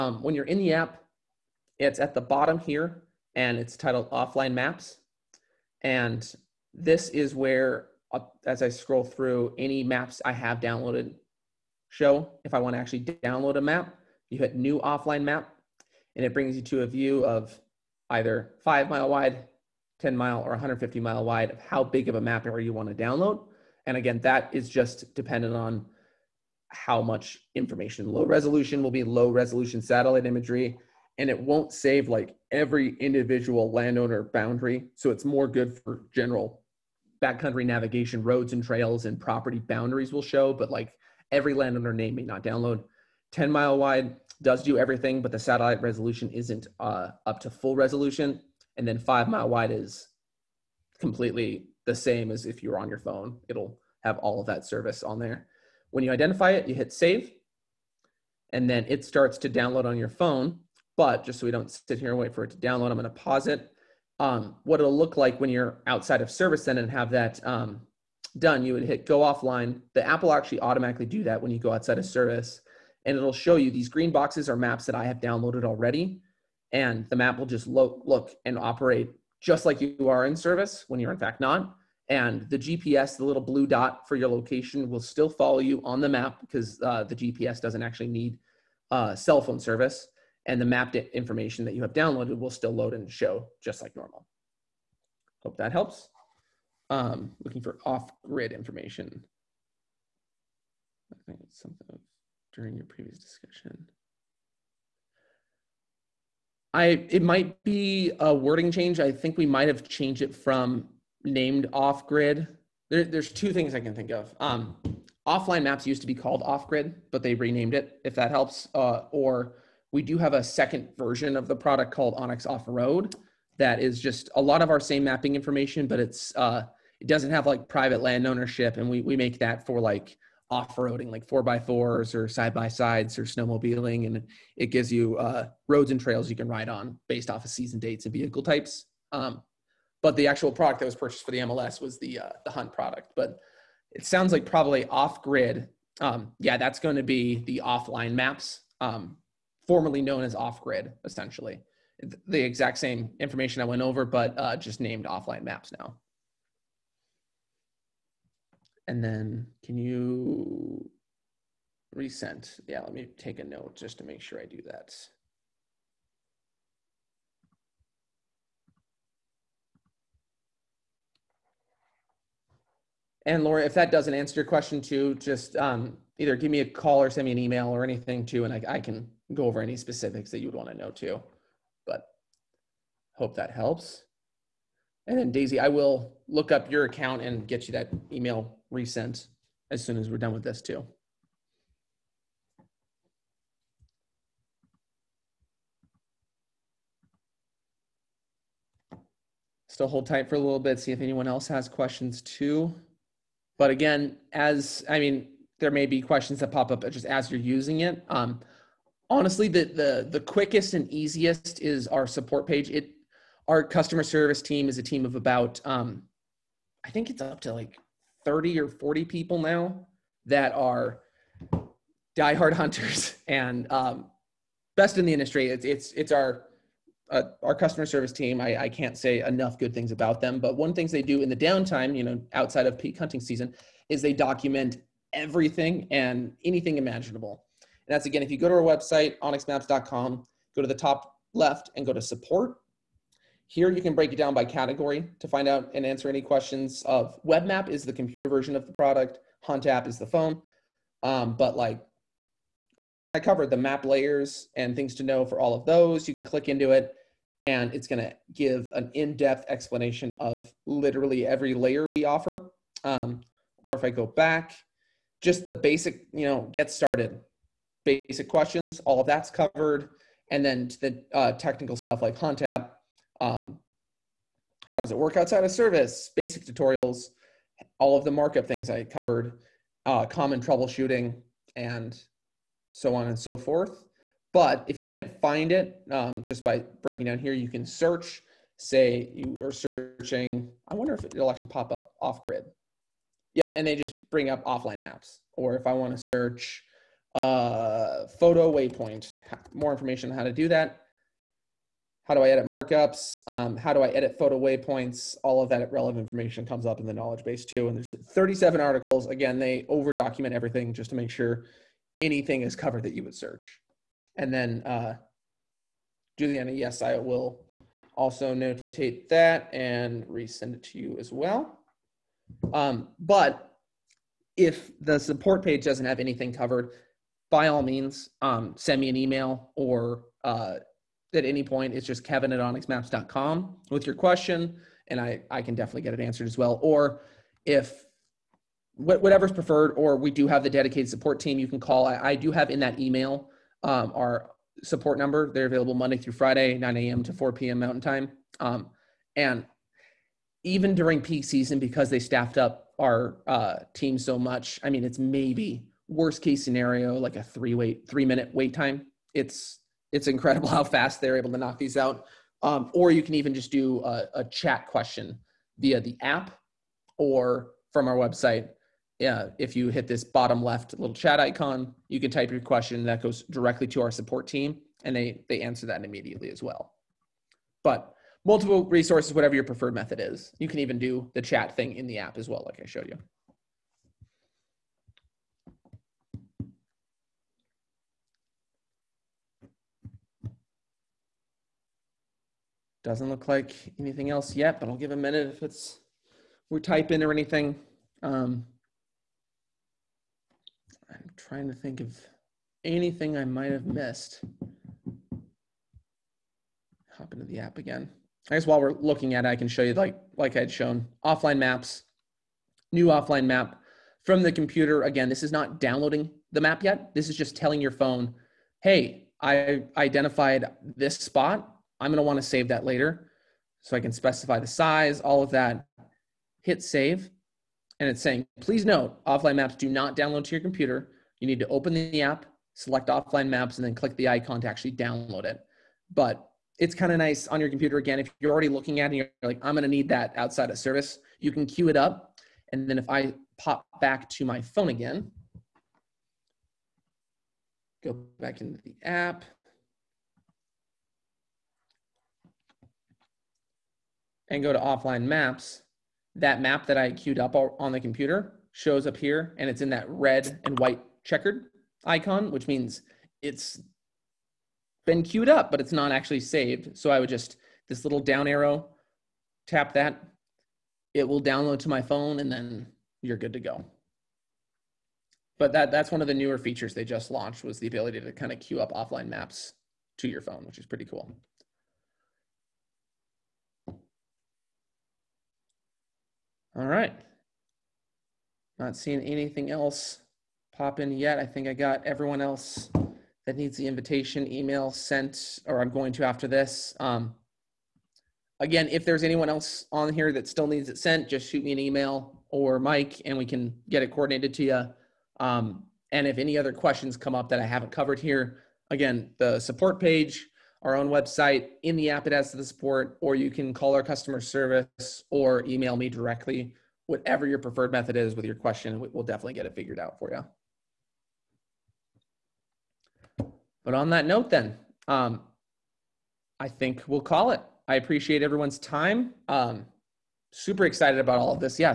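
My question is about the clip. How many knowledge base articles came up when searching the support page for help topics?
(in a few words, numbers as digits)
37.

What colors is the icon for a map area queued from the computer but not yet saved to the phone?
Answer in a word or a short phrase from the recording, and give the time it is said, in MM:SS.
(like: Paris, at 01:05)
Red and white checkered, at 07:39.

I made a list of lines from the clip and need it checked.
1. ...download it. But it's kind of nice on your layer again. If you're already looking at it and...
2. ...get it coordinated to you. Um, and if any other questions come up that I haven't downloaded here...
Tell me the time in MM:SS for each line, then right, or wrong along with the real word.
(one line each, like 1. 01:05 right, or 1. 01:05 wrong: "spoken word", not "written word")
1. 07:14 wrong: "computer", not "layer"
2. 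08:23 wrong: "covered", not "downloaded".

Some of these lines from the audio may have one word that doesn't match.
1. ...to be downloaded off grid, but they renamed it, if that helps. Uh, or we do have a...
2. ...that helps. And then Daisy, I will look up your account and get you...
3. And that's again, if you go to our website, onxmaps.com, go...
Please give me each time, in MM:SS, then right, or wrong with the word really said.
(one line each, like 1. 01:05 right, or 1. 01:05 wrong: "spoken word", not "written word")
1. 01:56 wrong: "called", not "downloaded"
2. 03:03 right
3. 03:57 right.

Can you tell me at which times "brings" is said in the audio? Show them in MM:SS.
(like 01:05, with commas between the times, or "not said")
00:16, 04:54.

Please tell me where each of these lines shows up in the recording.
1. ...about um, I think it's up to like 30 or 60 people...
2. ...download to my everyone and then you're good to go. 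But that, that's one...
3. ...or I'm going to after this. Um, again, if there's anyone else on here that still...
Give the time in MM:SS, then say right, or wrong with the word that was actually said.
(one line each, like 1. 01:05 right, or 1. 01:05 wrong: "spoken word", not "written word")
1. 03:35 wrong: "40", not "60"
2. 07:51 wrong: "phone", not "everyone"
3. 08:15 right.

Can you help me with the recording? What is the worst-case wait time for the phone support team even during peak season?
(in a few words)
3 minutes.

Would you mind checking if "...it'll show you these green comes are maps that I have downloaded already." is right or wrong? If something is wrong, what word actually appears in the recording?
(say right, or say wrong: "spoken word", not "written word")
wrong: "boxes", not "comes".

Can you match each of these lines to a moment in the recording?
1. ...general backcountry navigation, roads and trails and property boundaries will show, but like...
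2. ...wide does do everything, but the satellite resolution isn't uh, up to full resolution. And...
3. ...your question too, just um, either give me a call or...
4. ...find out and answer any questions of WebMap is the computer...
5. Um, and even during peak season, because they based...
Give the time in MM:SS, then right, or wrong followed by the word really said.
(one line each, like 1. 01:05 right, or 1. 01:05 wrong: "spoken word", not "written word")
1. 00:36 right
2. 00:43 right
3. 02:54 right
4. 04:05 right
5. 05:48 wrong: "staffed", not "based".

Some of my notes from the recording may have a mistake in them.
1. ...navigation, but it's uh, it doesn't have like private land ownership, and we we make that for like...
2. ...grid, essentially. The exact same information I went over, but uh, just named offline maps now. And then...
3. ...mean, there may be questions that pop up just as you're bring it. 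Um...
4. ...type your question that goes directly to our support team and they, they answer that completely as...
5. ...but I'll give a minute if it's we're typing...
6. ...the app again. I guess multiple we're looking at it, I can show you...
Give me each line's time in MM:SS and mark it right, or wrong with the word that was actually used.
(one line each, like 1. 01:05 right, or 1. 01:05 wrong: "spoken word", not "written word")
1. 02:05 wrong: "information", not "navigation"
2. 02:30 right
3. 03:25 wrong: "using", not "bring"
4. 06:12 wrong: "immediately", not "completely"
5. 06:34 right
6. 06:47 wrong: "while", not "multiple".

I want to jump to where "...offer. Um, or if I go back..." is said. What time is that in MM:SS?
04:22.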